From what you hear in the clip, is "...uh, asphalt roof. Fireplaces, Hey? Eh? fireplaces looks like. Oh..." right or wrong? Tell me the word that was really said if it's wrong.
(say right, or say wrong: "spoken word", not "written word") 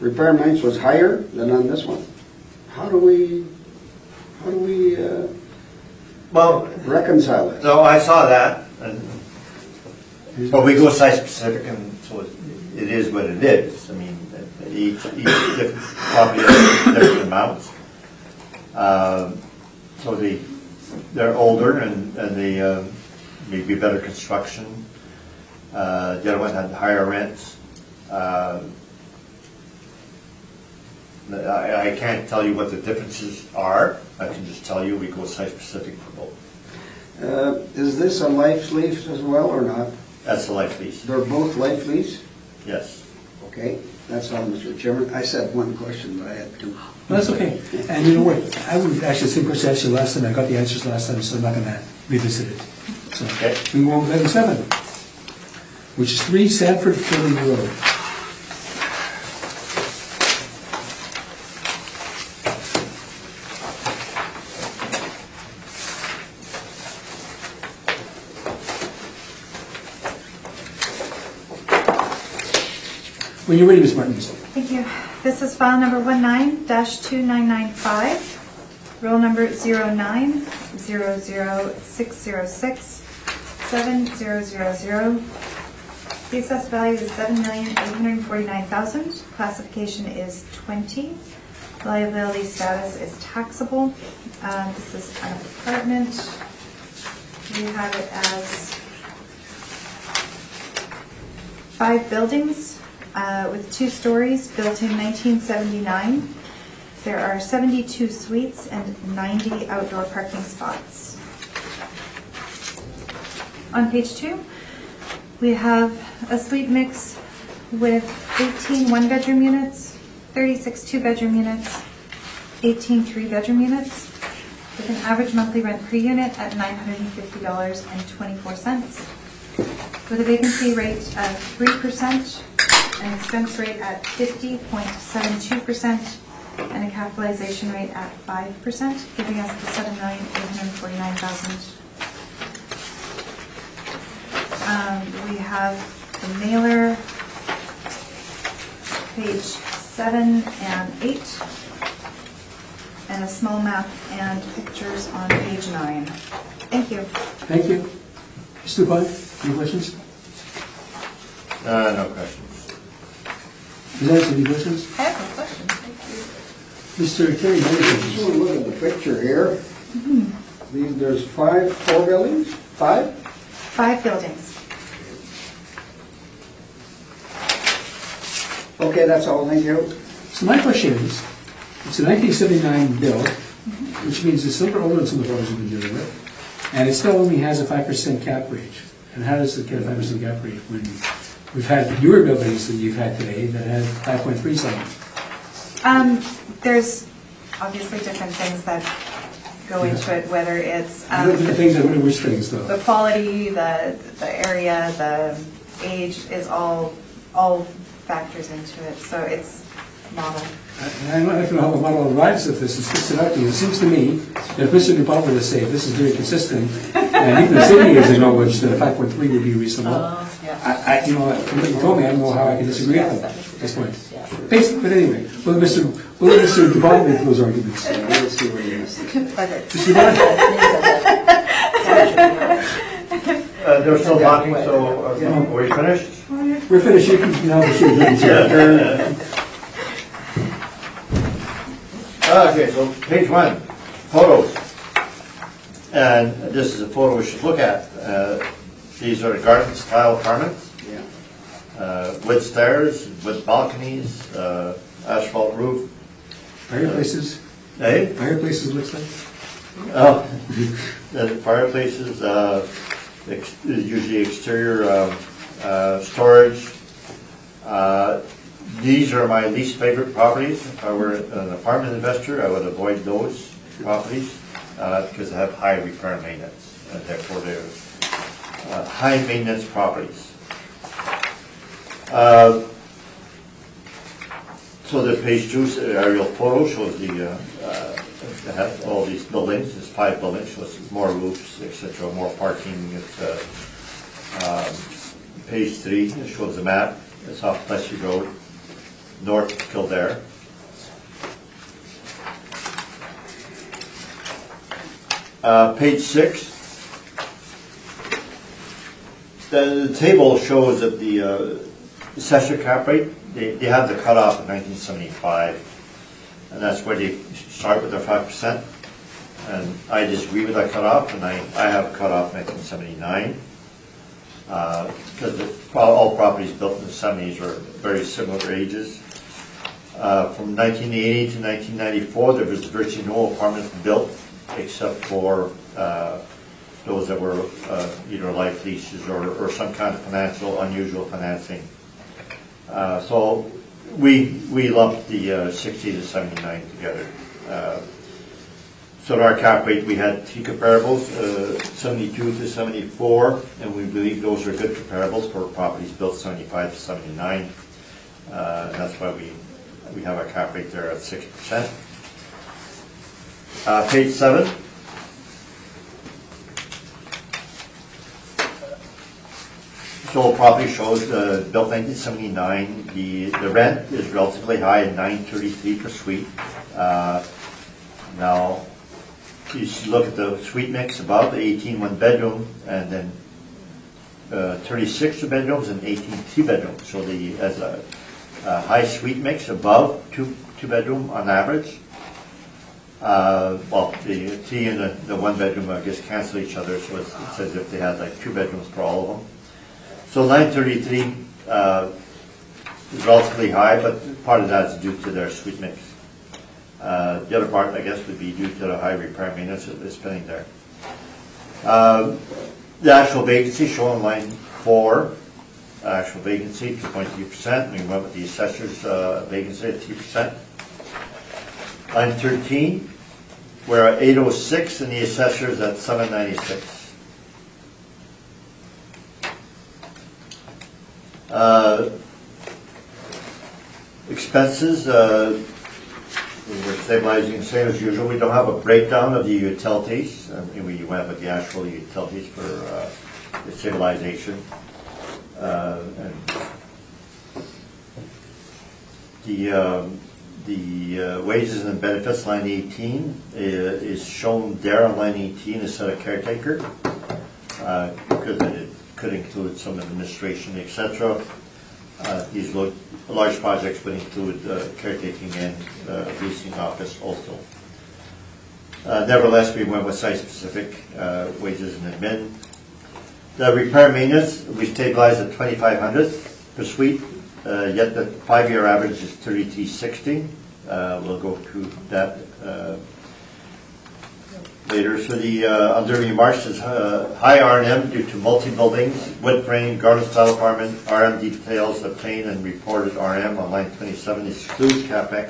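right.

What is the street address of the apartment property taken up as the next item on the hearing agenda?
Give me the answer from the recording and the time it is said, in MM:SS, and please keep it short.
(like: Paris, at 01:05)
3 Sandford Fleming Road, at 00:56.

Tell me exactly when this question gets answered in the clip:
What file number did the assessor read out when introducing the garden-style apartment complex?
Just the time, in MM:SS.
01:16.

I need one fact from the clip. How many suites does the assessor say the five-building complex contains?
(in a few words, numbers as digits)
72.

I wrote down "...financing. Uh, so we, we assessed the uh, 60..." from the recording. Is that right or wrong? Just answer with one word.
wrong.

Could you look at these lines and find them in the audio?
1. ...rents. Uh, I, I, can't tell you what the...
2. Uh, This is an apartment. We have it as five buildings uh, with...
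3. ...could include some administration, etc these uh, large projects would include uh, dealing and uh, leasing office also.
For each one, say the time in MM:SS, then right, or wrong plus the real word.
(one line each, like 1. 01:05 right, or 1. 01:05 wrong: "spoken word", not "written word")
1. 00:27 right
2. 01:34 right
3. 07:38 wrong: "caretaking", not "dealing".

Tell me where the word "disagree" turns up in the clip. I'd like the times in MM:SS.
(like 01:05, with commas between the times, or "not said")
03:42, 05:20.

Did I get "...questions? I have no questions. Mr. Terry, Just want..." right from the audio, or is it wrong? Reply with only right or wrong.
right.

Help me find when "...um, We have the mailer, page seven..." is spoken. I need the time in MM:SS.
02:24.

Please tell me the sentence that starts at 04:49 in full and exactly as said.
It's five buildings, so it's more roofs, etc., more parking.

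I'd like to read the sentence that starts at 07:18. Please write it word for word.
We don't have a breakdown of the utilities.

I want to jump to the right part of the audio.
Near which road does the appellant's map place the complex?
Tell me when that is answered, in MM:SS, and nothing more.
04:57.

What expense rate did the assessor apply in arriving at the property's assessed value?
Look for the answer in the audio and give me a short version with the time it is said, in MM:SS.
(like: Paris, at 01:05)
50.72%, at 02:14.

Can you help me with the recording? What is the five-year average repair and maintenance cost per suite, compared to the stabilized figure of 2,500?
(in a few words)
3360.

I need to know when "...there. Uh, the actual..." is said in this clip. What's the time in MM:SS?
06:50.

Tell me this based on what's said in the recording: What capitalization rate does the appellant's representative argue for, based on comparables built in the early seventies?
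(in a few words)
6%.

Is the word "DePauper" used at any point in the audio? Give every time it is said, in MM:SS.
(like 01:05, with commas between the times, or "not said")
03:34, 03:46.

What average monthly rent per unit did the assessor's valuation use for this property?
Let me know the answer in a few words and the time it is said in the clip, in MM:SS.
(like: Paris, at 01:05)
$950.24, at 02:06.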